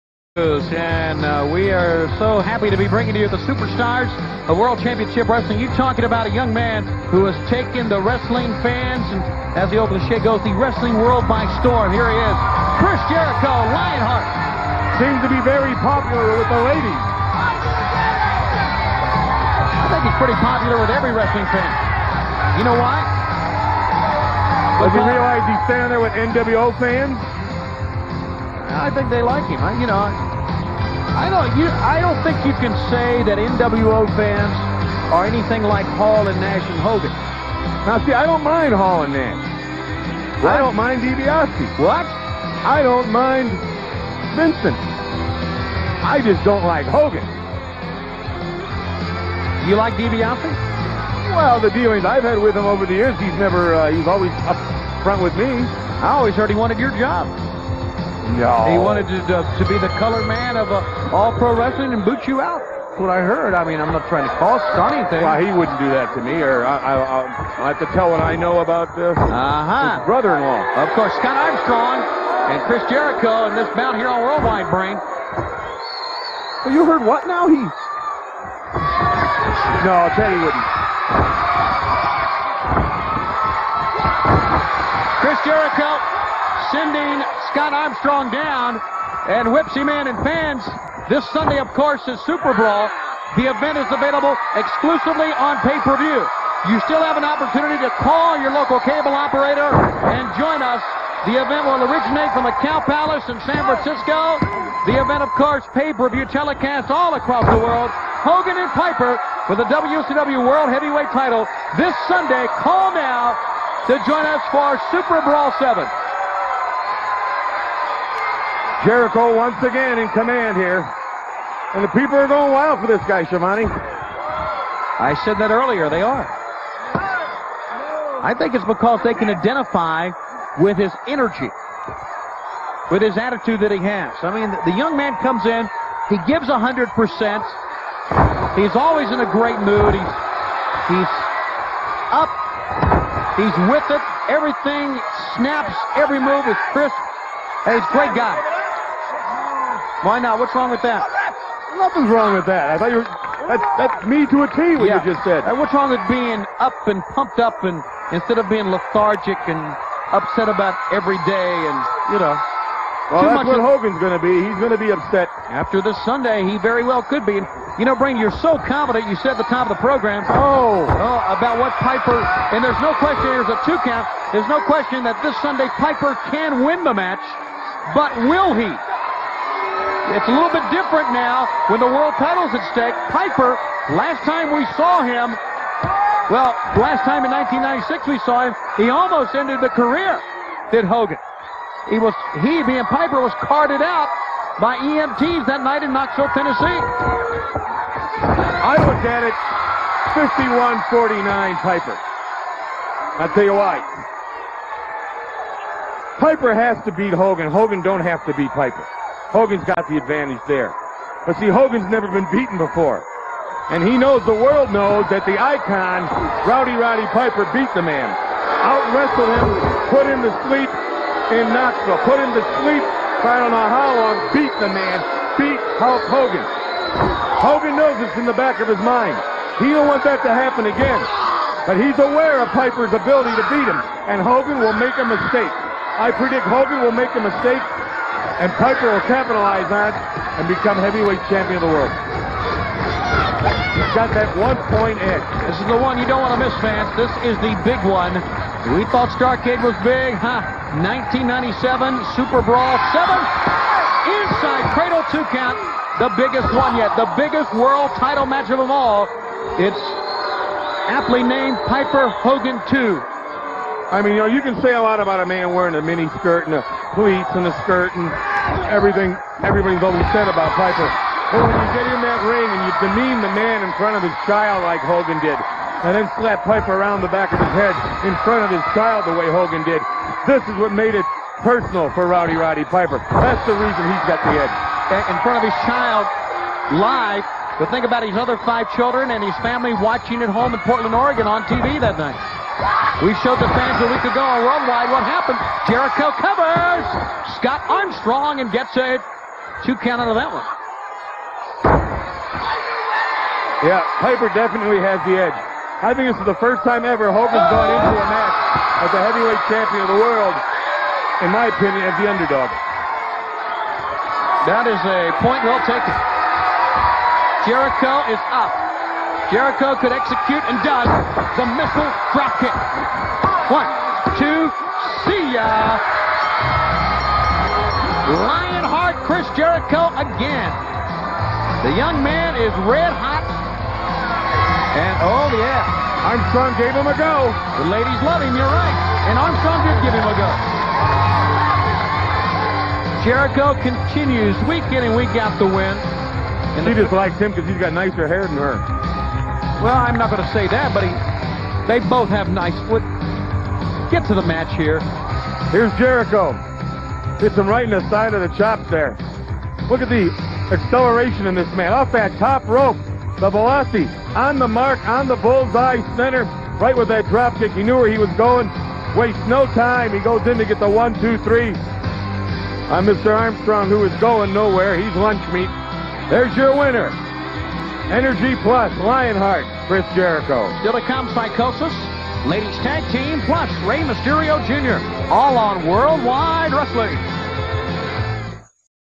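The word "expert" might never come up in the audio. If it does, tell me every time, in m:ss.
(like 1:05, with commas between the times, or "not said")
not said.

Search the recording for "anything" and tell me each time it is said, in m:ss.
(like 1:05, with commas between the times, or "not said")
0:35, 1:04.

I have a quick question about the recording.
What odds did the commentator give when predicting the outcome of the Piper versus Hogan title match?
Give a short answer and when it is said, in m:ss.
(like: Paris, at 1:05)
51-49, at 3:20.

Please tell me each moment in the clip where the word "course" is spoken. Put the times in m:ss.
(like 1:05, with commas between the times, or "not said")
1:10, 1:31, 1:45.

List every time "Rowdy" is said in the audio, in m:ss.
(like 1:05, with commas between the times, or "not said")
3:36, 4:42.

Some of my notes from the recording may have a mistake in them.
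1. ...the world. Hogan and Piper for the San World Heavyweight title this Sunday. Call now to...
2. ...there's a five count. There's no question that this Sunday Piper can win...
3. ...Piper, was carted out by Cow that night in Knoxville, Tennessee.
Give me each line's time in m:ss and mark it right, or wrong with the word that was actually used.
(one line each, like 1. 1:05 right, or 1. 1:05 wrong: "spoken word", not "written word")
1. 1:47 wrong: "WCW", not "San"
2. 2:53 wrong: "two", not "five"
3. 3:12 wrong: "EMTs", not "Cow".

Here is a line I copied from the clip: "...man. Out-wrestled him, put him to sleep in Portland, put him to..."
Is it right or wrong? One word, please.
wrong.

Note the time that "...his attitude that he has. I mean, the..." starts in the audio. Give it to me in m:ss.
2:13.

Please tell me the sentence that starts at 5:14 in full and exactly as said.
That is a point well taken.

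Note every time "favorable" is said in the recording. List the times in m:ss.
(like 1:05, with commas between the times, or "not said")
not said.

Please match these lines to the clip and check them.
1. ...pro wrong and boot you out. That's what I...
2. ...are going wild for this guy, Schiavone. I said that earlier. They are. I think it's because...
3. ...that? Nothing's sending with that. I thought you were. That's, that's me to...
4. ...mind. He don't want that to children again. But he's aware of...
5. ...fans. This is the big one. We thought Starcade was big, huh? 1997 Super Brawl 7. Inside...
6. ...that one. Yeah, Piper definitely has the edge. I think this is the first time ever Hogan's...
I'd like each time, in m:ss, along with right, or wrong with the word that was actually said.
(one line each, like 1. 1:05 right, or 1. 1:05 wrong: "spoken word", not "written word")
1. 1:01 wrong: "wrestling", not "wrong"
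2. 2:02 right
3. 2:30 wrong: "wrong", not "sending"
4. 3:48 wrong: "happen", not "children"
5. 4:06 right
6. 5:00 right.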